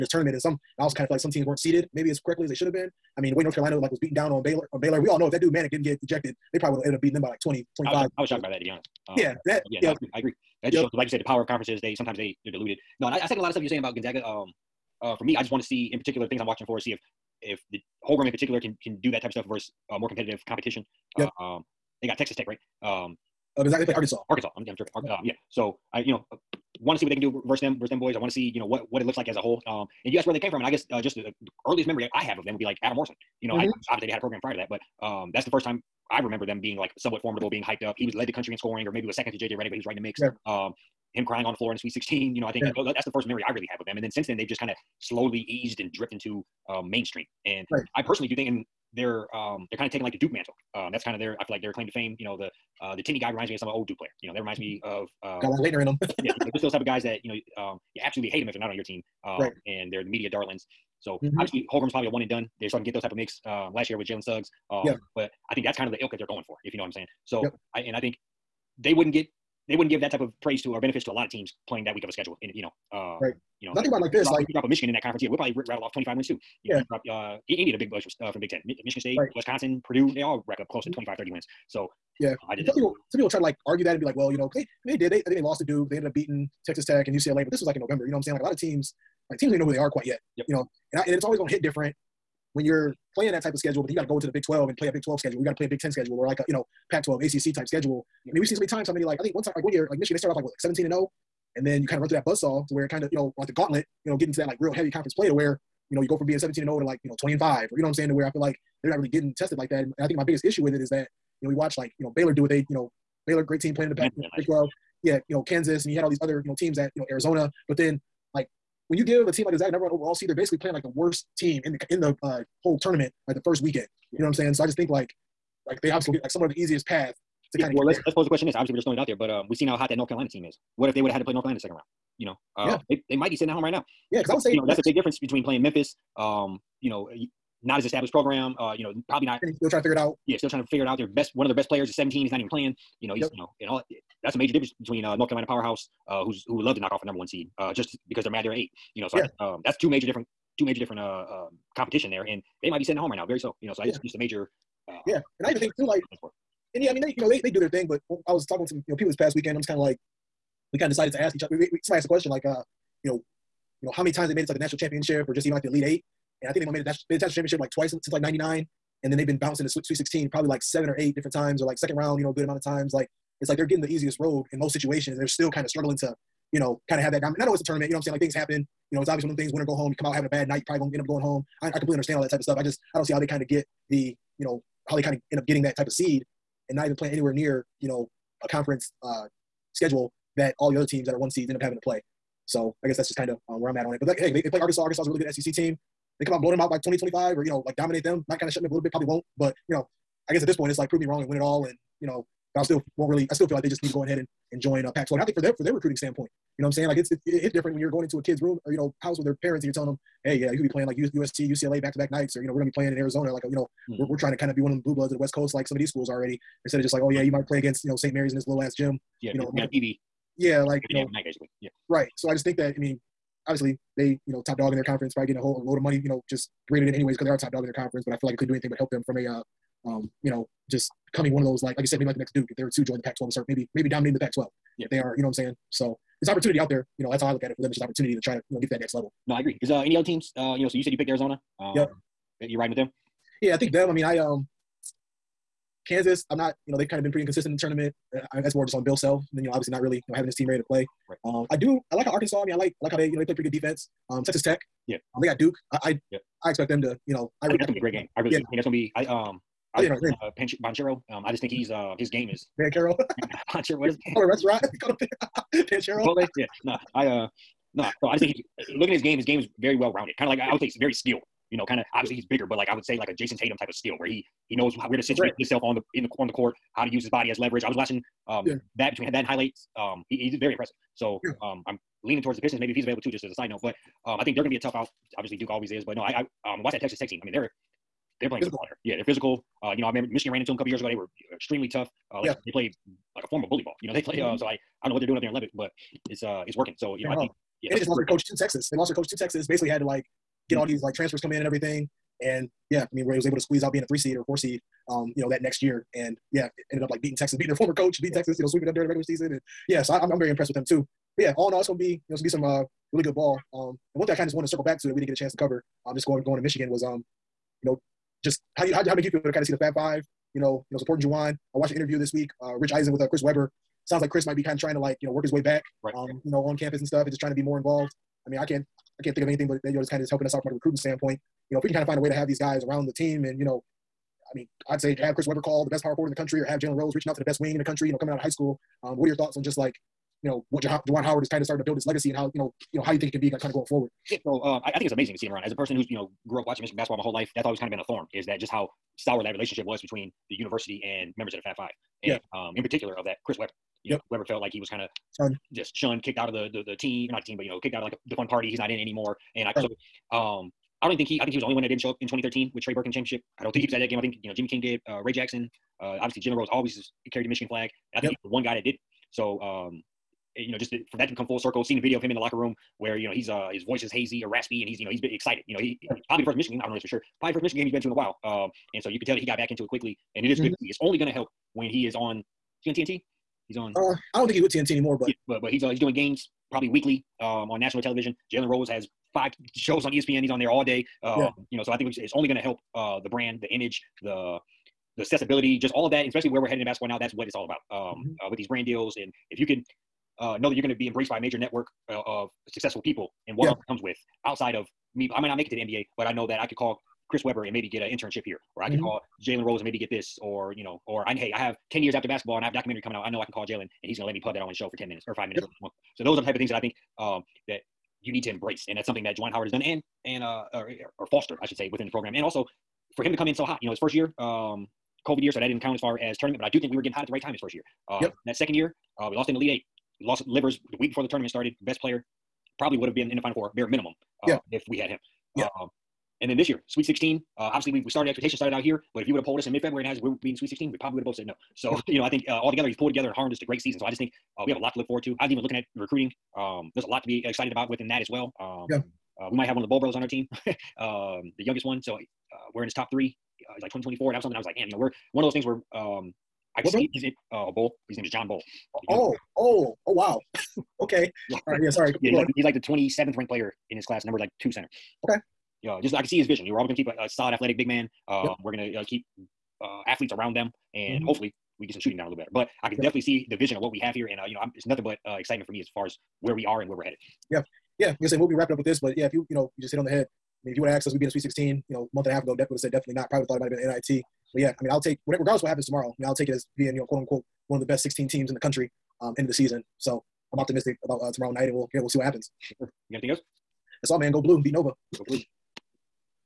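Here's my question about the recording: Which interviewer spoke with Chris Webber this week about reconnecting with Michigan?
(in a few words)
Rich Eisen.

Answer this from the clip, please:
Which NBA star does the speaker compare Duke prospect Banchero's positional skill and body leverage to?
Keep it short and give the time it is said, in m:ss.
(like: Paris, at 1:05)
Jayson Tatum, at 4:33.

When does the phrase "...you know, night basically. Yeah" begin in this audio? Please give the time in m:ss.
3:40.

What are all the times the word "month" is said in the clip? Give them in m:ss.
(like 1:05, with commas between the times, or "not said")
8:01.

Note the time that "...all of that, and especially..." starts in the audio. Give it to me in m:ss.
6:35.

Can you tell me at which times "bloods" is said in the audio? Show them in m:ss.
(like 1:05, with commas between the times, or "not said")
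3:34.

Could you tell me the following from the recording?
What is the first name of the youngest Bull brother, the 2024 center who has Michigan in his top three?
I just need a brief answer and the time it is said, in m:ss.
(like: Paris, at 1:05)
John, at 7:38.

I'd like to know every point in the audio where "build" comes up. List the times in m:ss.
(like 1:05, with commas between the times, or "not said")
5:41.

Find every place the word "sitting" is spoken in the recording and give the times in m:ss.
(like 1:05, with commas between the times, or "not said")
2:13, 2:32.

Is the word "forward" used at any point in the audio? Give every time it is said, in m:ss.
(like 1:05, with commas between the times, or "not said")
5:35, 5:43, 7:24.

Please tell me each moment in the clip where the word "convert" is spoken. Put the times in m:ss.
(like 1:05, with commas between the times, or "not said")
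not said.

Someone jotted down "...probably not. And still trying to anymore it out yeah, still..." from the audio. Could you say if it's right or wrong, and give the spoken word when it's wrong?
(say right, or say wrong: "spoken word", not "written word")
wrong: "figure", not "anymore".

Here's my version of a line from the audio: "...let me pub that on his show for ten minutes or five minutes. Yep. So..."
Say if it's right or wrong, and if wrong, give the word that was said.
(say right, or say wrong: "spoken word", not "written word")
right.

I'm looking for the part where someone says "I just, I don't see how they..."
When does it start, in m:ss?
3:02.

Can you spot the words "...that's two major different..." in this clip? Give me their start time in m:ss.
2:29.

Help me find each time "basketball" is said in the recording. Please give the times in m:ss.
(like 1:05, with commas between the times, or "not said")
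5:46, 6:36, 6:52.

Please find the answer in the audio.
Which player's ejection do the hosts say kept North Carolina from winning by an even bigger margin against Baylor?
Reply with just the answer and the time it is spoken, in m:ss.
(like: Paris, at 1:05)
Manek, at 0:05.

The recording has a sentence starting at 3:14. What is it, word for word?
But that, hey, they, they play Arkansas.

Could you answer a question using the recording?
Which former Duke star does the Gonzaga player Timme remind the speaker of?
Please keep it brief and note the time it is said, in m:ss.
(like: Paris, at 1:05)
Laettner, at 0:55.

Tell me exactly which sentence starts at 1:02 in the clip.
They're starting to get those type of mix um, last year with Jalen Suggs.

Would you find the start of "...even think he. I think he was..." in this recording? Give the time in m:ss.
6:00.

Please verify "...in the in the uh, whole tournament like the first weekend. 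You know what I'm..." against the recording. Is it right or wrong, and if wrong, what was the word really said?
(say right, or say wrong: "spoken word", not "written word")
right.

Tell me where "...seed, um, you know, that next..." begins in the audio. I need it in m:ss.
5:04.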